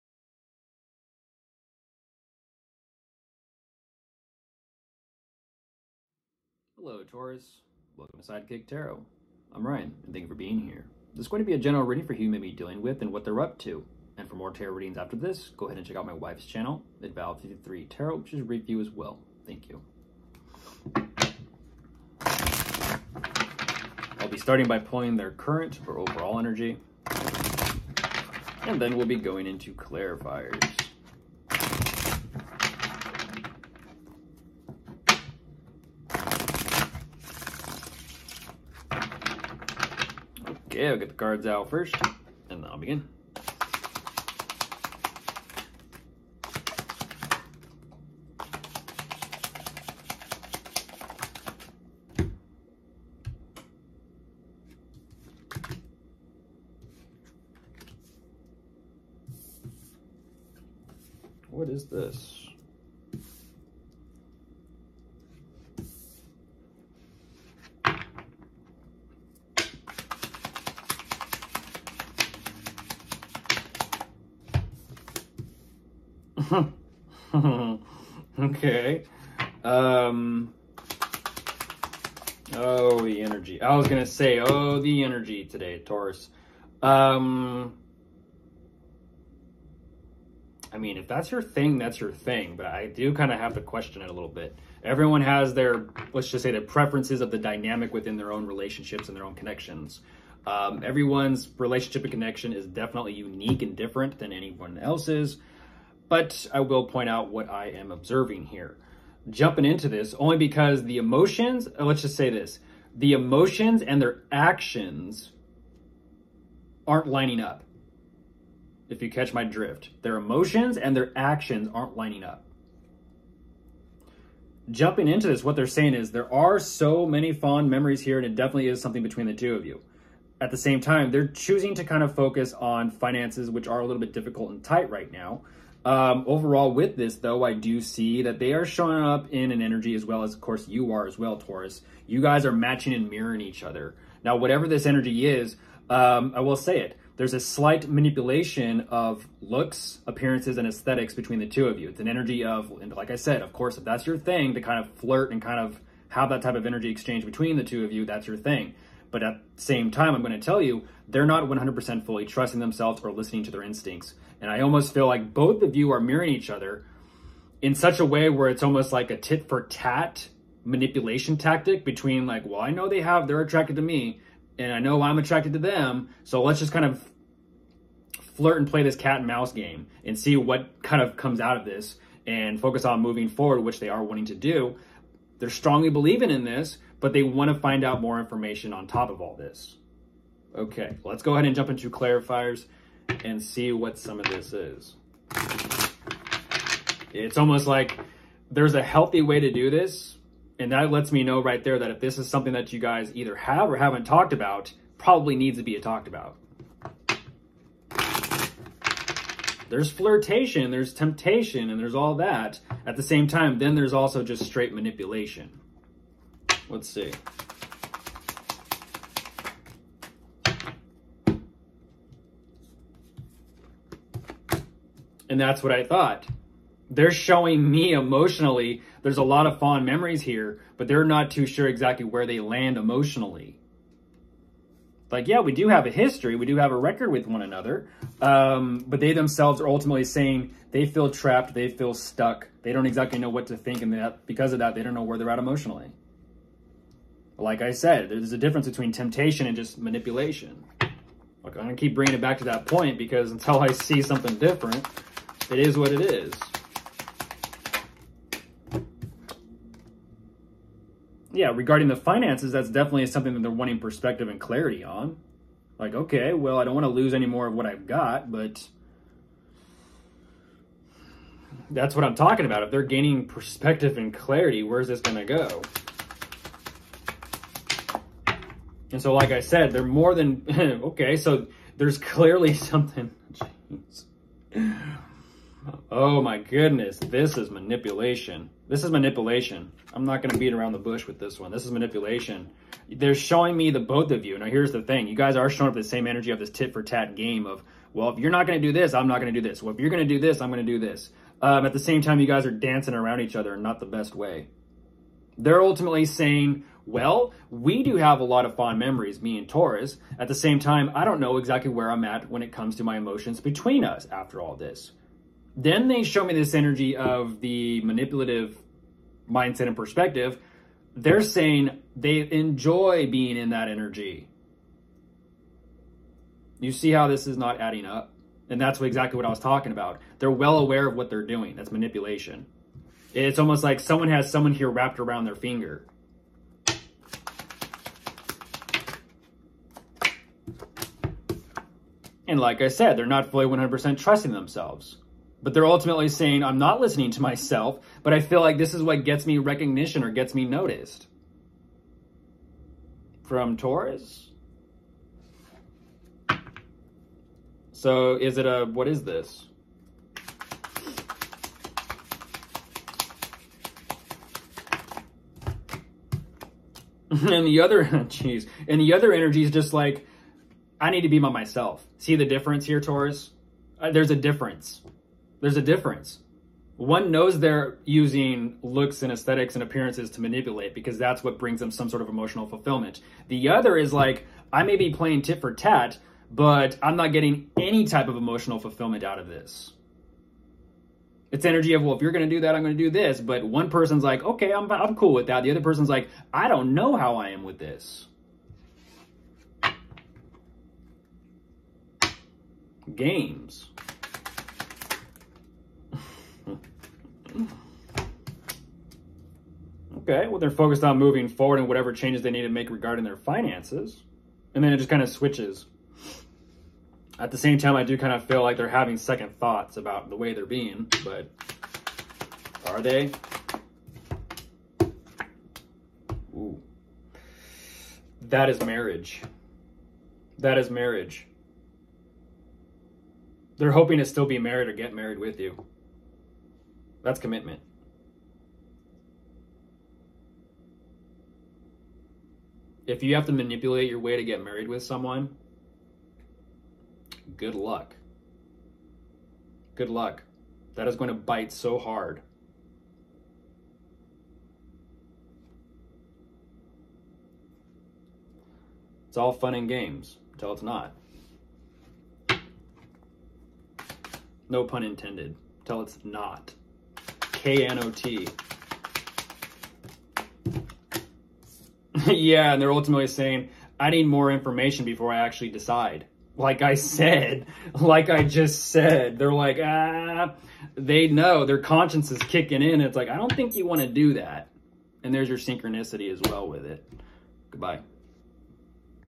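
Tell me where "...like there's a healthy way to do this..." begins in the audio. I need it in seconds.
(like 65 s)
197 s.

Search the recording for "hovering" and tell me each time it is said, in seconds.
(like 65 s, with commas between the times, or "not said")
not said.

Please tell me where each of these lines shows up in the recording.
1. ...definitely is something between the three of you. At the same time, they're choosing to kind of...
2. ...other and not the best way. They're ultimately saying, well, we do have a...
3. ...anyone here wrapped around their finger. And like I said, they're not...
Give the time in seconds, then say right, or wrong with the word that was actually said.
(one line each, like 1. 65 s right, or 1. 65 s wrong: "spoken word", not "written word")
1. 128 s wrong: "two", not "three"
2. 303 s right
3. 334 s wrong: "someone", not "anyone".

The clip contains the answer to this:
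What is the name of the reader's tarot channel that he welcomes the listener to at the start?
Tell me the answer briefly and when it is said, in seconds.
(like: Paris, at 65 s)
Sidekick Tarot, at 8 s.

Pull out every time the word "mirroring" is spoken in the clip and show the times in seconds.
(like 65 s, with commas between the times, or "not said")
143 s, 165 s.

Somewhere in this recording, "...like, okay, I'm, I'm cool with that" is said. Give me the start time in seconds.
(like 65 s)
394 s.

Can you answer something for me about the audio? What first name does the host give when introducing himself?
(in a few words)
Ryan.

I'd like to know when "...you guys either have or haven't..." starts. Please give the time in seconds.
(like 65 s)
202 s.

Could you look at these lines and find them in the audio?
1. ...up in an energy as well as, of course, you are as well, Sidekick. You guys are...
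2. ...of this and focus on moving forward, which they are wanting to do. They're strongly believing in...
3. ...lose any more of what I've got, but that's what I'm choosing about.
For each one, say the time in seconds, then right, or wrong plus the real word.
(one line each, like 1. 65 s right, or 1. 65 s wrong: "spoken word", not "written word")
1. 139 s wrong: "Taurus", not "Sidekick"
2. 181 s right
3. 266 s wrong: "talking", not "choosing".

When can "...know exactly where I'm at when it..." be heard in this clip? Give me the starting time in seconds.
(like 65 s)
311 s.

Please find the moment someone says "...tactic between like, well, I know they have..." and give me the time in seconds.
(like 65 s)
171 s.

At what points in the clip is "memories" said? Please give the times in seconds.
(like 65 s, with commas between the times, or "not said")
127 s, 229 s, 308 s.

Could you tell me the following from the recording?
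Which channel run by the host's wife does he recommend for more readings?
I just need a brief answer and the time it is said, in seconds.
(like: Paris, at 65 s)
Adval53 Tarot, at 17 s.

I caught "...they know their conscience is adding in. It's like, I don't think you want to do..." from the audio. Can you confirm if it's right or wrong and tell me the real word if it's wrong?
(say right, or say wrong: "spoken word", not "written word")
wrong: "kicking", not "adding".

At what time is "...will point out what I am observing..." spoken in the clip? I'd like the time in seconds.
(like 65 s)
106 s.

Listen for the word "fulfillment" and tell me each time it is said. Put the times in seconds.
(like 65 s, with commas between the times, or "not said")
382 s, 388 s.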